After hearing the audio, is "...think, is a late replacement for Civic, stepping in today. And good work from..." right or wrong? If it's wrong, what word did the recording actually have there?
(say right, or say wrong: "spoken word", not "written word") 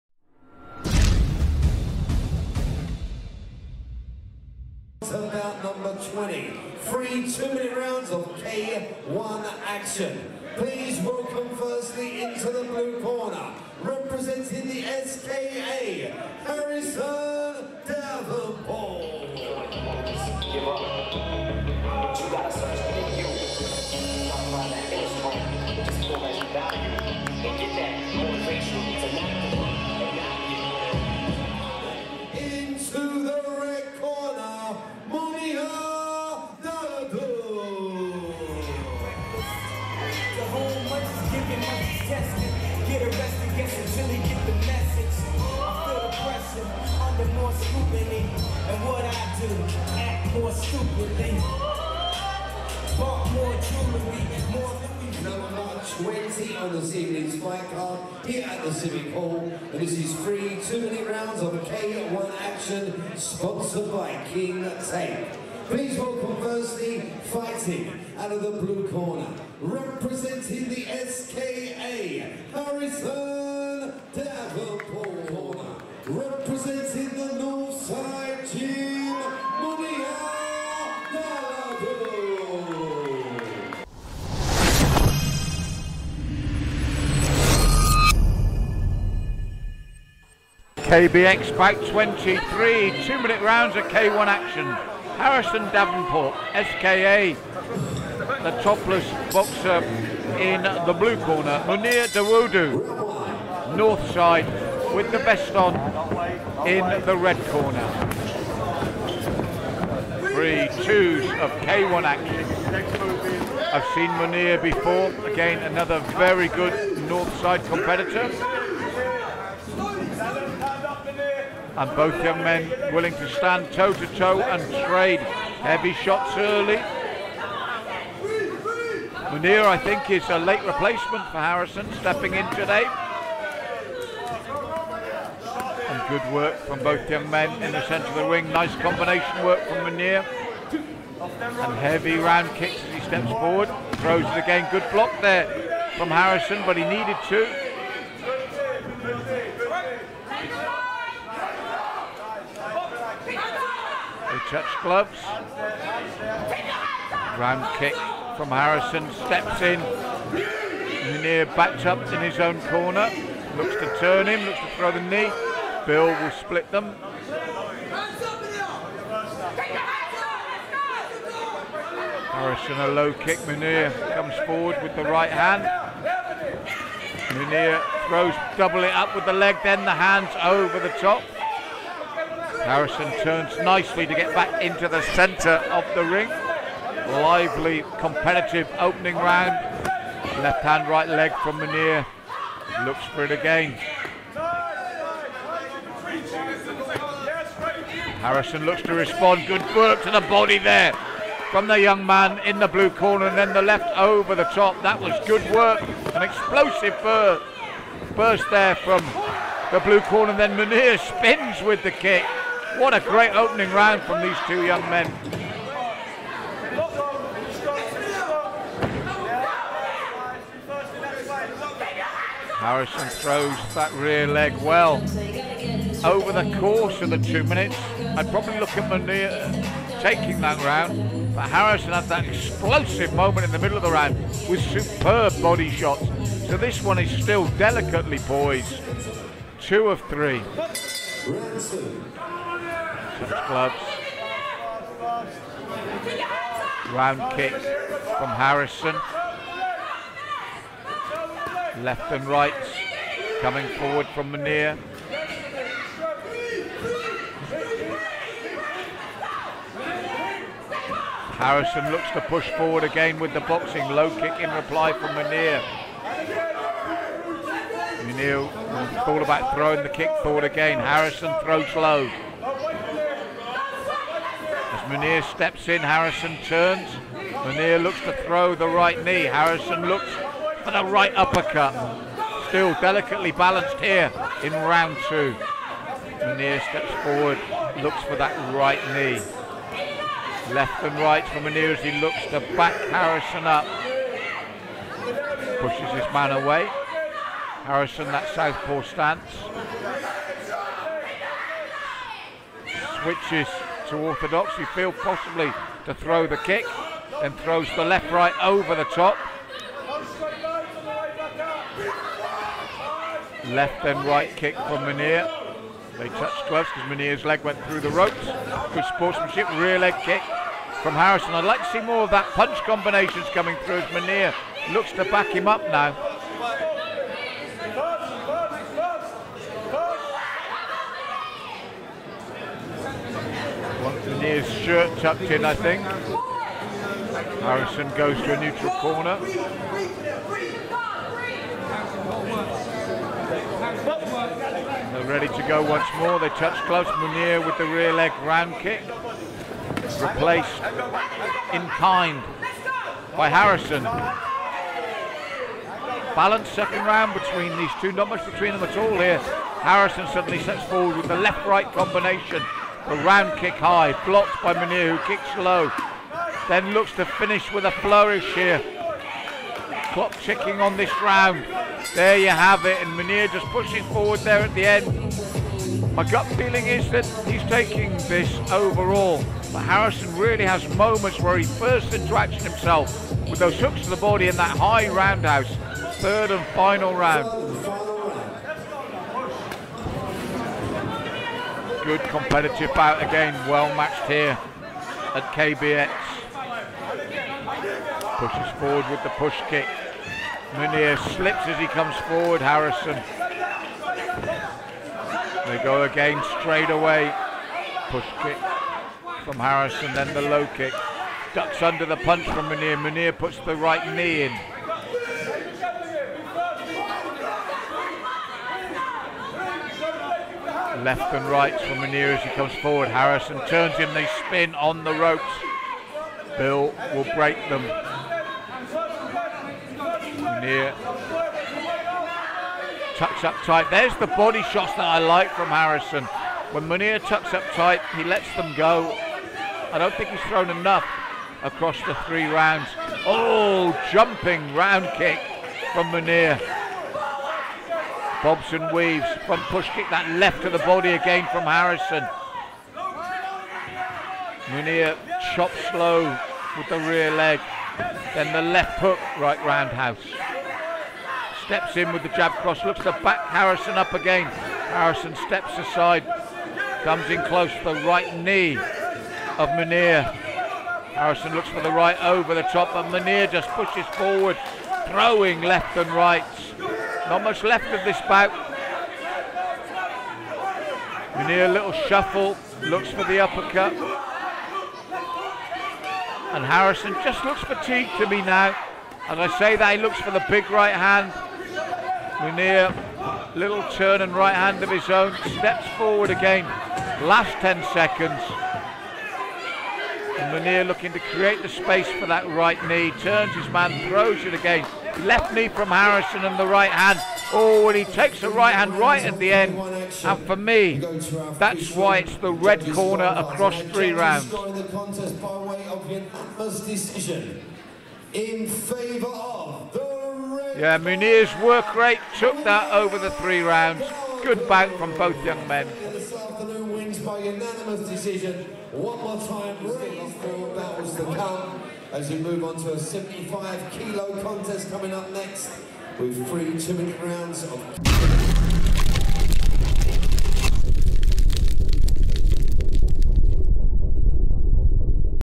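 wrong: "Harrison", not "Civic".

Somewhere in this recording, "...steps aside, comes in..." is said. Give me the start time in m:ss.
7:45.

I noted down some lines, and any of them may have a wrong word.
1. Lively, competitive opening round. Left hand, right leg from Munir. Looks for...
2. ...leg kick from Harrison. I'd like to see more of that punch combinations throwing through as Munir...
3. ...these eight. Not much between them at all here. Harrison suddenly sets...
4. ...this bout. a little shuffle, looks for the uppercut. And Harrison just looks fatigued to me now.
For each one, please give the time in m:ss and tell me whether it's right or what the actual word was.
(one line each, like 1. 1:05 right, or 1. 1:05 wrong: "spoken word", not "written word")
1. 3:07 right
2. 5:19 wrong: "coming", not "throwing"
3. 5:57 wrong: "two", not "eight"
4. 7:57 right.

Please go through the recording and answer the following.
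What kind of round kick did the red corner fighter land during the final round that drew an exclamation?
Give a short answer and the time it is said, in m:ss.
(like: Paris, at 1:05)
Jumping round kick, at 7:23.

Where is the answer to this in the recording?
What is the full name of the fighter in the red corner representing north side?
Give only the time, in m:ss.
1:41.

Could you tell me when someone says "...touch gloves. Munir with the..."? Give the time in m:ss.
5:46.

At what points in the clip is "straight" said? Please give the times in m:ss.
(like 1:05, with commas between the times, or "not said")
6:46.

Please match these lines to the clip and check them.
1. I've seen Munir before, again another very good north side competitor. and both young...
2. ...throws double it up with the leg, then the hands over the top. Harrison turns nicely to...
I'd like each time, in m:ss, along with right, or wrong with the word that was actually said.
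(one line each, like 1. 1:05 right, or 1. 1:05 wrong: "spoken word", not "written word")
1. 1:53 right
2. 2:58 right.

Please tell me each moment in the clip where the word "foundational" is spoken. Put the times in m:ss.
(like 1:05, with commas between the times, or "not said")
not said.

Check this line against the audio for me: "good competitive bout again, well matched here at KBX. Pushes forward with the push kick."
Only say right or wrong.
right.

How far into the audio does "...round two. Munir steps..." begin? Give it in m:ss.
4:44.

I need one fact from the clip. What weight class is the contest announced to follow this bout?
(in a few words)
75 kilo.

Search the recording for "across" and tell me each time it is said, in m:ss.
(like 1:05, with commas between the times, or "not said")
7:21, 8:33.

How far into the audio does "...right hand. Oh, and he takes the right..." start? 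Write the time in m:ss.
8:26.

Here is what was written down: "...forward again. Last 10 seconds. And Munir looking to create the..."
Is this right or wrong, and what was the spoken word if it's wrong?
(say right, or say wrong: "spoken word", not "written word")
right.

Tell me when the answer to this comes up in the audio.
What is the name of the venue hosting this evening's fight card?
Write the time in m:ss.
0:58.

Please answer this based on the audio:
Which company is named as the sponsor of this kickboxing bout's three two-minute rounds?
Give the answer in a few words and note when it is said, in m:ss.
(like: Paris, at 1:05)
King Tape, at 1:04.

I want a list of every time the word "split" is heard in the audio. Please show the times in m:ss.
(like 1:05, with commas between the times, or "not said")
2:46.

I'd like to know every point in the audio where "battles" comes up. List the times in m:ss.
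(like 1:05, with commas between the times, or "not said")
8:50.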